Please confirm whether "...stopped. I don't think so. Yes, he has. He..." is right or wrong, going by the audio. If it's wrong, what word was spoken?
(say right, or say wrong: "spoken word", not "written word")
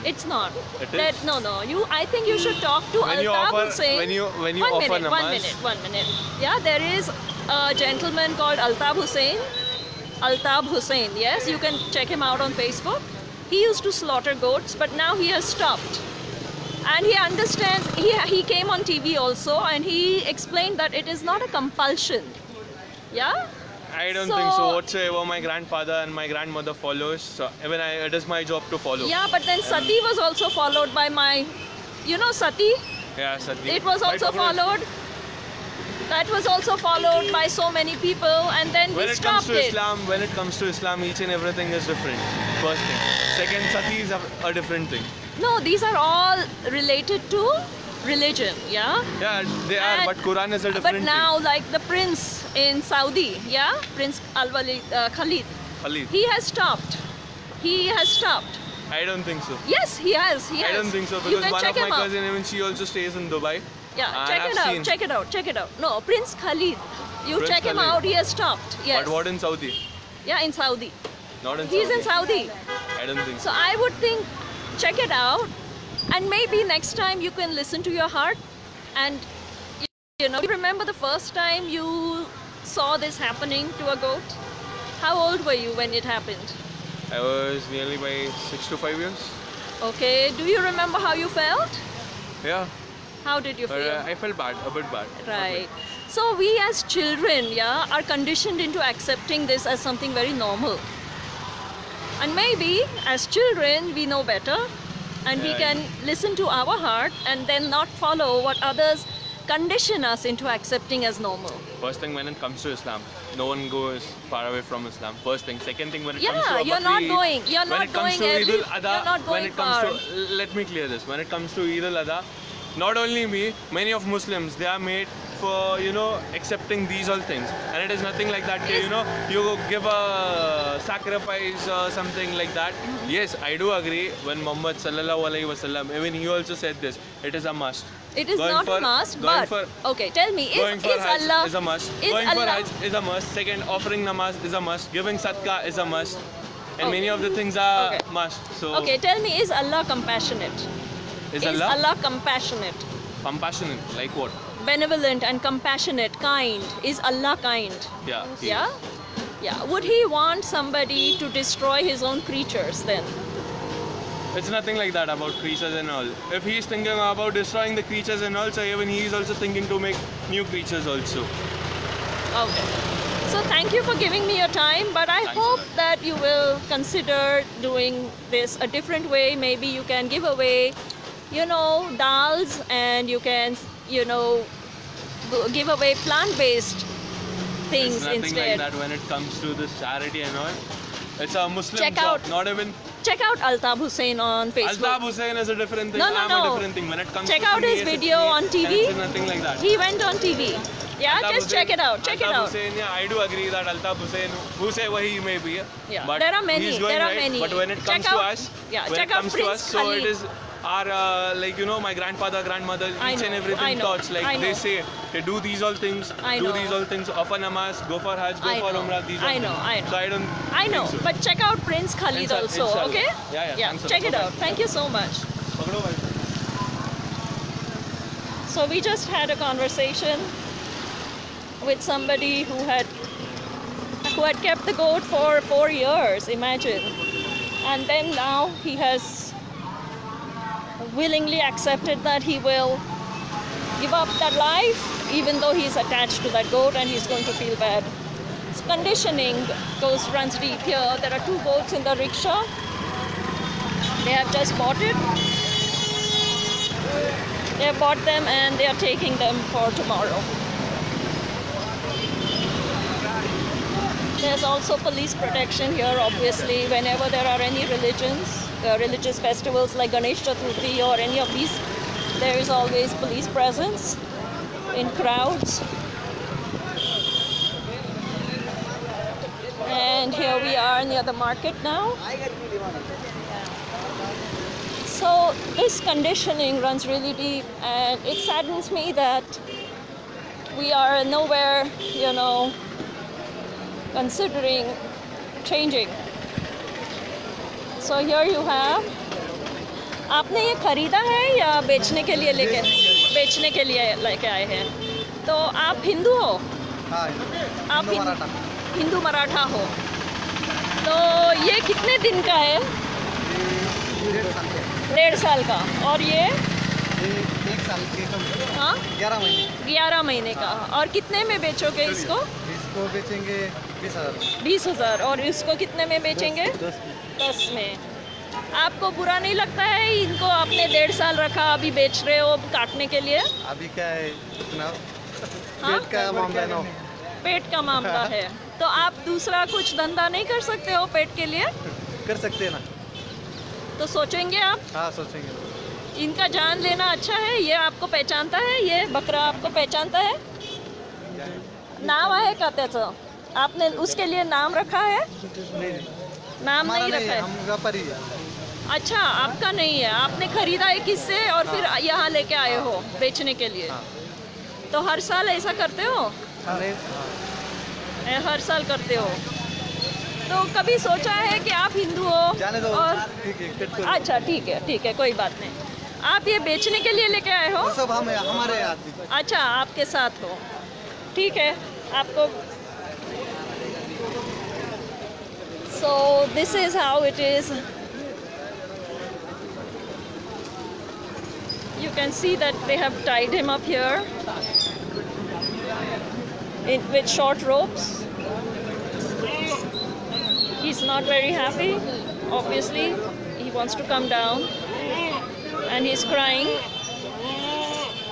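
right.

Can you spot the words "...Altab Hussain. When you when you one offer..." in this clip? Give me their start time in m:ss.
0:03.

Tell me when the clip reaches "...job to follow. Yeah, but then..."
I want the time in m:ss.
0:28.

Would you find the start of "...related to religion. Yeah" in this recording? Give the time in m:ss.
0:46.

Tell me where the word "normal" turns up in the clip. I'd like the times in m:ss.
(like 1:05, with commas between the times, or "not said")
1:40, 1:51.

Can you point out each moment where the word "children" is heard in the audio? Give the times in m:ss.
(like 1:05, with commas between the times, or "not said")
1:36, 1:43.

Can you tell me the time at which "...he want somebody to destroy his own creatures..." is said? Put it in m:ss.
2:39.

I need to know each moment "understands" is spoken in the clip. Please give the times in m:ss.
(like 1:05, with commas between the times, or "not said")
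0:17.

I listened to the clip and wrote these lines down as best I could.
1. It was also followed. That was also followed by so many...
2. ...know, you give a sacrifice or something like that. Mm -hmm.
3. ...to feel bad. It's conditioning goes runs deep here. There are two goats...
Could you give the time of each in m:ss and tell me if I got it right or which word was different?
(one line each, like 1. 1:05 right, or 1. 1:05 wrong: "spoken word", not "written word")
1. 0:33 right
2. 2:08 right
3. 4:07 right.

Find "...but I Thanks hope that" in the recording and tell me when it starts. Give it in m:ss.
2:54.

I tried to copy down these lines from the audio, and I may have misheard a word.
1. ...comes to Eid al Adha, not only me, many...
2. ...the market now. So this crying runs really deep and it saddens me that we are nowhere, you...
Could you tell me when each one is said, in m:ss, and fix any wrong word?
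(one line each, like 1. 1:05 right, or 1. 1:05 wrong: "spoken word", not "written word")
1. 2:01 right
2. 4:41 wrong: "conditioning", not "crying".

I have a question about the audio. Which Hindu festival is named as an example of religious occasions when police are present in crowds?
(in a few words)
Ganesh Chaturthi.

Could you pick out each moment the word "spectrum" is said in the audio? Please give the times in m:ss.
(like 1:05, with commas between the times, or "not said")
not said.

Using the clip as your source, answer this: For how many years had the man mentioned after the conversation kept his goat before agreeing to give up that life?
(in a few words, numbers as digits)
4.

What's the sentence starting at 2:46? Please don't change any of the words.
If he's thinking about destroying the creatures and all, so even he's also thinking to make new creatures also.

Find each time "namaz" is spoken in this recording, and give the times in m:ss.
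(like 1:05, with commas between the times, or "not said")
2:24, 3:37.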